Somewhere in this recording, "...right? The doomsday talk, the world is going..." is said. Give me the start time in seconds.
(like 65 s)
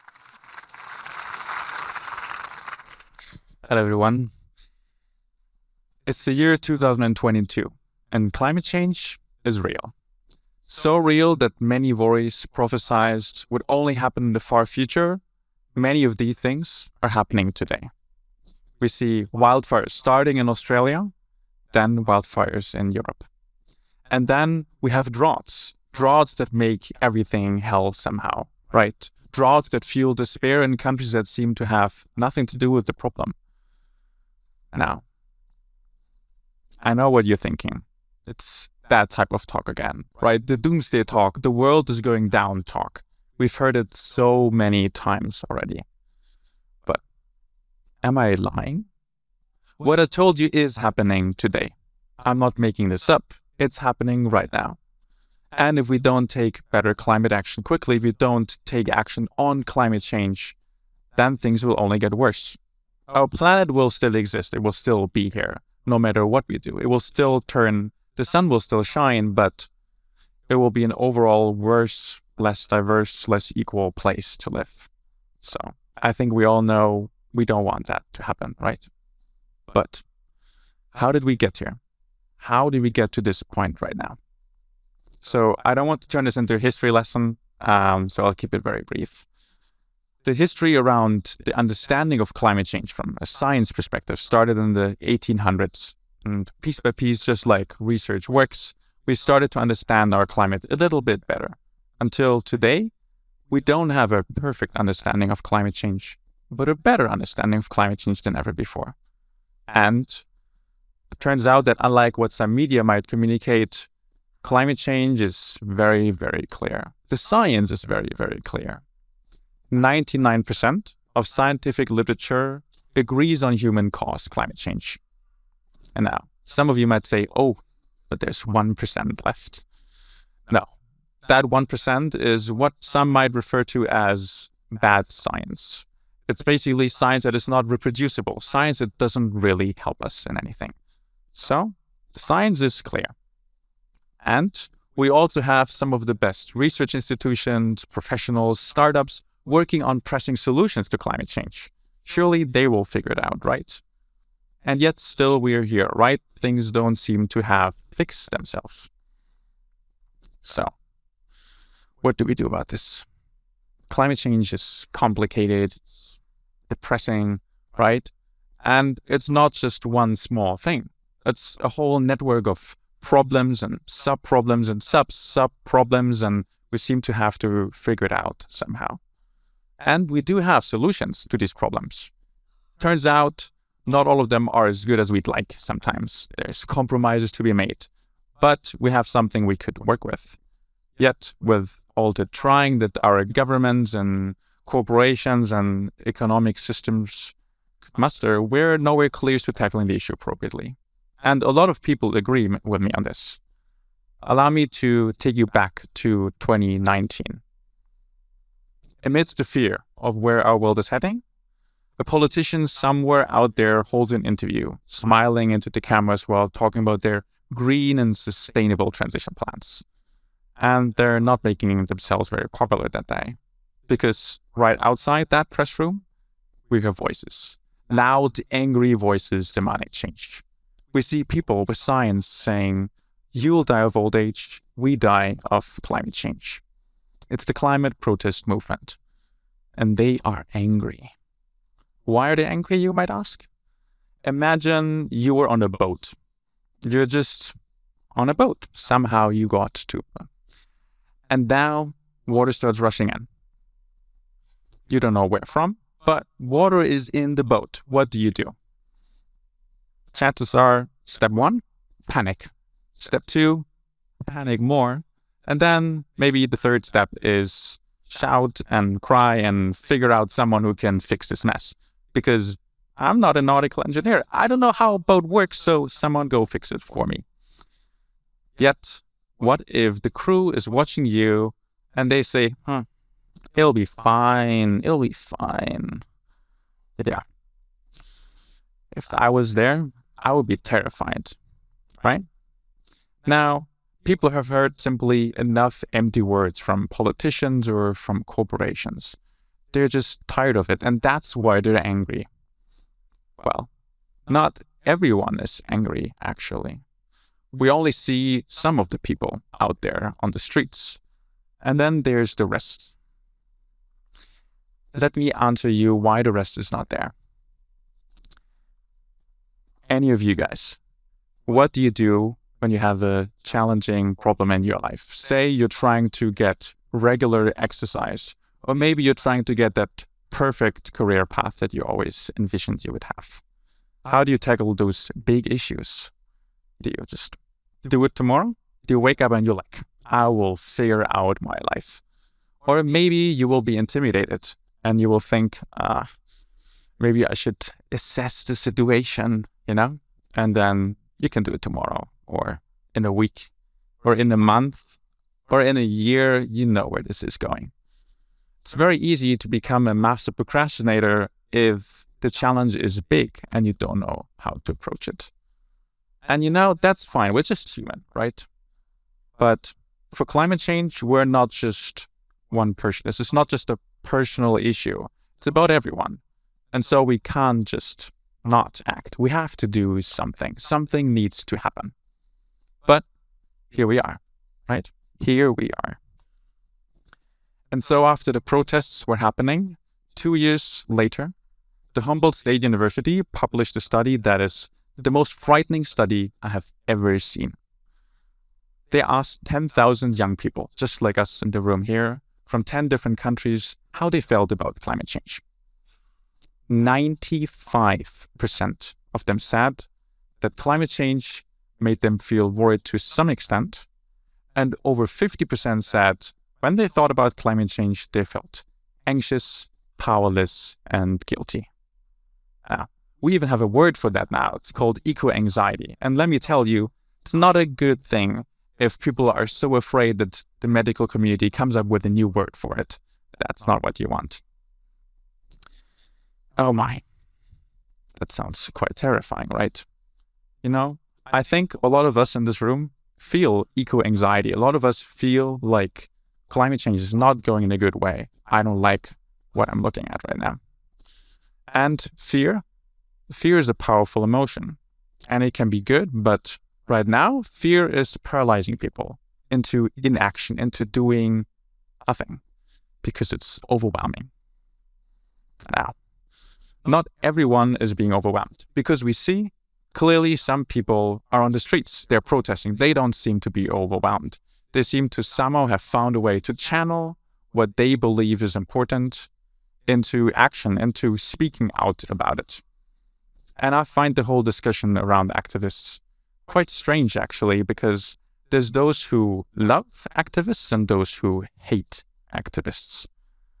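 40 s.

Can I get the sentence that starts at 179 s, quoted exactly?
And we do have solutions to these problems.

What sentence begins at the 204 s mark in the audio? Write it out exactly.
Allow me to take you back to 2019.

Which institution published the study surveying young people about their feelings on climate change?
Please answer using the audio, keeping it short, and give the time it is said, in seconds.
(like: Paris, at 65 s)
Humboldt State University, at 392 s.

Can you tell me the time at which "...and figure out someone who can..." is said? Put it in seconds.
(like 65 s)
269 s.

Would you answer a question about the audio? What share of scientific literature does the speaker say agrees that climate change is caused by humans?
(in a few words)
99%.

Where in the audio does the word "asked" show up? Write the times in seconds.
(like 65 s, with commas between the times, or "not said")
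399 s.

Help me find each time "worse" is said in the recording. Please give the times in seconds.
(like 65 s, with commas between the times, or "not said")
62 s, 71 s.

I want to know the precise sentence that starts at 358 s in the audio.
It's very easy to become a master procrastinator if the challenge is big and you don't know how to approach it.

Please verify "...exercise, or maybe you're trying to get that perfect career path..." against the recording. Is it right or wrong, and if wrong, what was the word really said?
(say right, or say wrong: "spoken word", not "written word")
right.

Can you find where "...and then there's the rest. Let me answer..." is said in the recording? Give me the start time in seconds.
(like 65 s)
311 s.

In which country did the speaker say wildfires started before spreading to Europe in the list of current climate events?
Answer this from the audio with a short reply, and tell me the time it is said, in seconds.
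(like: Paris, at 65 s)
Australia, at 20 s.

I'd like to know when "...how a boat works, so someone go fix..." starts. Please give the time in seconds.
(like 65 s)
274 s.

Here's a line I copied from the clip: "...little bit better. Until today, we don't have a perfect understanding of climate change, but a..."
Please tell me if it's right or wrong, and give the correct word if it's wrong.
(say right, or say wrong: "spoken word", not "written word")
right.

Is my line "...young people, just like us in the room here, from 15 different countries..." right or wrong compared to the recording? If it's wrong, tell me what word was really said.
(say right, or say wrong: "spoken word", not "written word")
wrong: "10", not "15".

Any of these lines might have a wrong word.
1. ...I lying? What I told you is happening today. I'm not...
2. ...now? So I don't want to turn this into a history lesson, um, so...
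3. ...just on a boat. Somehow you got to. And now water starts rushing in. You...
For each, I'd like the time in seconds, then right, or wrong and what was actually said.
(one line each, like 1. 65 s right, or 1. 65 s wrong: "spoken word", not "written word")
1. 48 s right
2. 83 s right
3. 247 s right.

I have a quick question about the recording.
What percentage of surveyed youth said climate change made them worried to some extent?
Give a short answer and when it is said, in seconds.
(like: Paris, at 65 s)
95%, at 406 s.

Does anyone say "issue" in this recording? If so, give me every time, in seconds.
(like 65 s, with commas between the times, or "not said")
199 s, 335 s, 374 s.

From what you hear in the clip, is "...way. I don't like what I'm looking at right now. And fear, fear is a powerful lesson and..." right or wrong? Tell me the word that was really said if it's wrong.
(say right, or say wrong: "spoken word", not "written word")
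wrong: "emotion", not "lesson".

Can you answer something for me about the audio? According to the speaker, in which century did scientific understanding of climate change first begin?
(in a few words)
1800s.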